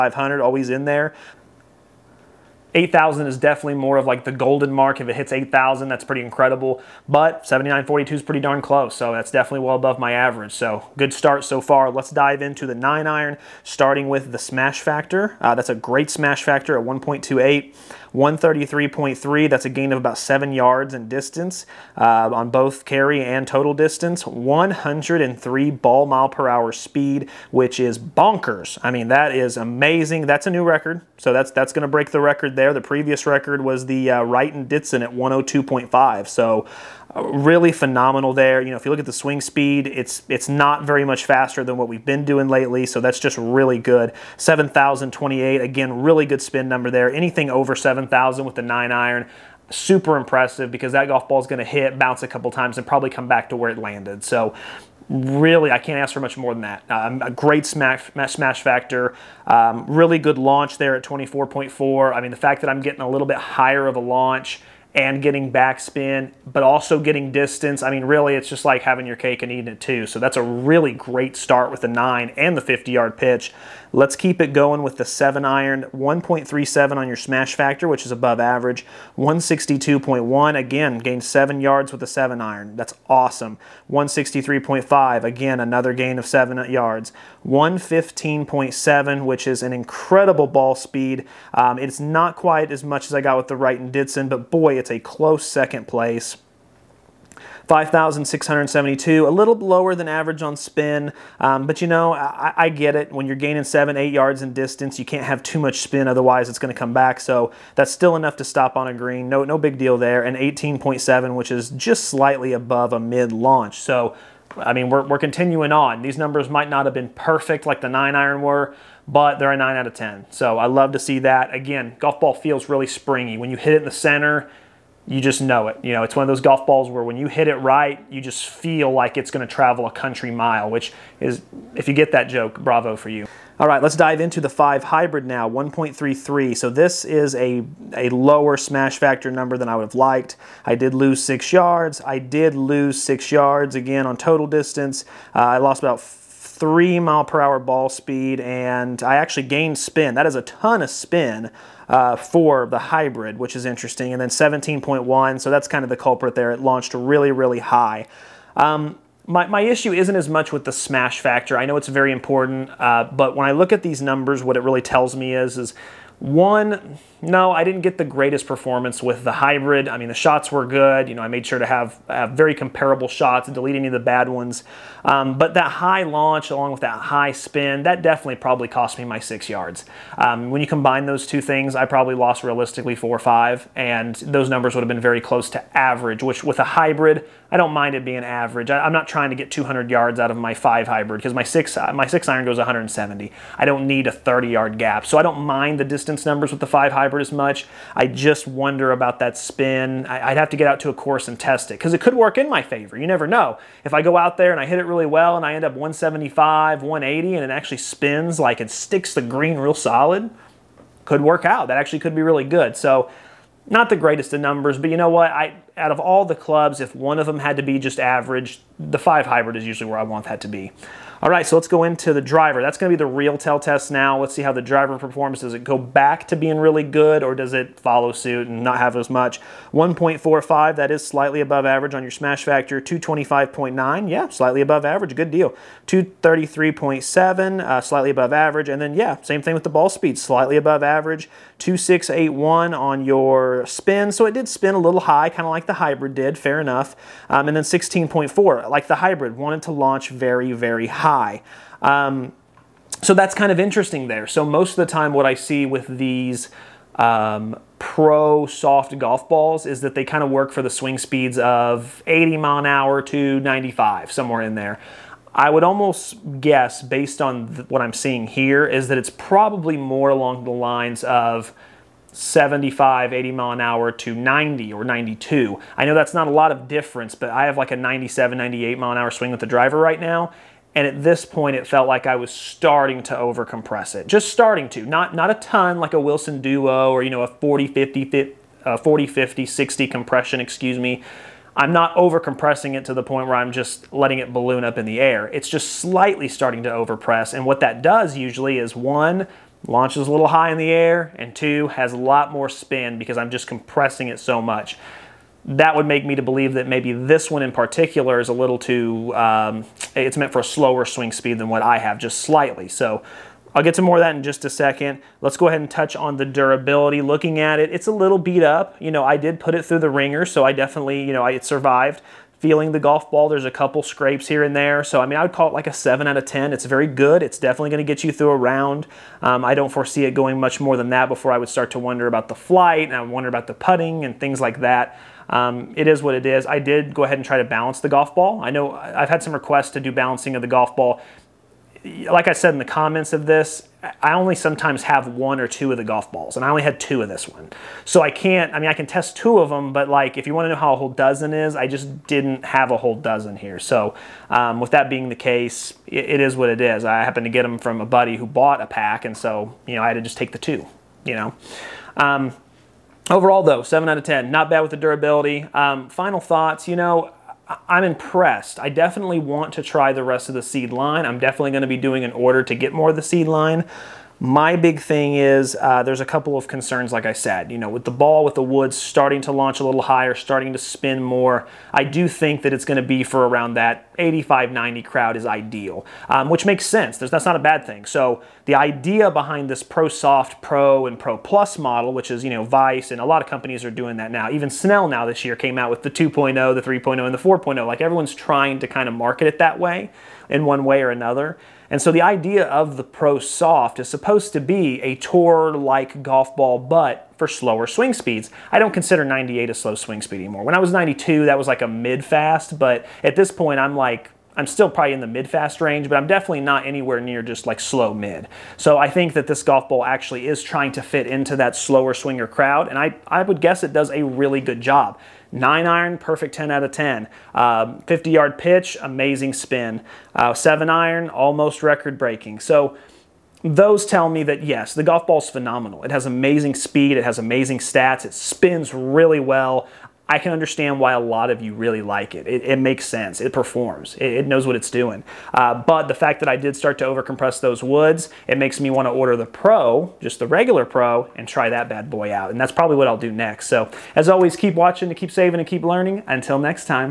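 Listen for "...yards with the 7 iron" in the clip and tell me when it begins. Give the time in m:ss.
1:21.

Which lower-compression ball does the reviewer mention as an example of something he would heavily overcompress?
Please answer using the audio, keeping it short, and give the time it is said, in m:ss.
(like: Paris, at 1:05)
Wilson Duo, at 4:45.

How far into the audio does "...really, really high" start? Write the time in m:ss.
2:36.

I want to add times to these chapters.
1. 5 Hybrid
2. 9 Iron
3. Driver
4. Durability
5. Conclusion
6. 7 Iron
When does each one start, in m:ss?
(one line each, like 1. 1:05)
1. 2:13
2. 0:13
3. 3:49
4. 5:16
5. 6:06
6. 1:14.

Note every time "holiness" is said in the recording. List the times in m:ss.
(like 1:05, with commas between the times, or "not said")
not said.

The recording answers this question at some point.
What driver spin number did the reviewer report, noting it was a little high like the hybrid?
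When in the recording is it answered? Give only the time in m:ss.
4:01.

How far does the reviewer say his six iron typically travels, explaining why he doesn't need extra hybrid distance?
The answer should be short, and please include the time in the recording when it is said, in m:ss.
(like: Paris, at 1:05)
170, at 3:11.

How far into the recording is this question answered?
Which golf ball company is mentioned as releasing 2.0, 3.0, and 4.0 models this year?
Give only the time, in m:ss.
6:34.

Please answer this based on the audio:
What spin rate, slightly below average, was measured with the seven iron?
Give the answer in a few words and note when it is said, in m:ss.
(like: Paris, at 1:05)
5,672, at 1:37.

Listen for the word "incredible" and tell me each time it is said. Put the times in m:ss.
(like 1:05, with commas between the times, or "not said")
0:06, 1:29.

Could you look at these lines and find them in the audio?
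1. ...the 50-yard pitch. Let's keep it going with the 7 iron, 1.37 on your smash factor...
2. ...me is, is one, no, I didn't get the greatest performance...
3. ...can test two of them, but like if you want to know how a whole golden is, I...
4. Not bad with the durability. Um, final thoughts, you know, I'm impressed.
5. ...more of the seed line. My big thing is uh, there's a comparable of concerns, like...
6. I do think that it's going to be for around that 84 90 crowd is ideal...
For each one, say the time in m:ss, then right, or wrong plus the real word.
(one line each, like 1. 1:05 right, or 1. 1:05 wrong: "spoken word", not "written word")
1. 1:12 right
2. 2:45 right
3. 5:48 wrong: "dozen", not "golden"
4. 6:04 right
5. 6:12 wrong: "couple", not "comparable"
6. 6:21 wrong: "85", not "84".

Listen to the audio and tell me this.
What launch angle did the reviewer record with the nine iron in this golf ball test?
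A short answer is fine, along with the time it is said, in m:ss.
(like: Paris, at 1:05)
24.4, at 1:01.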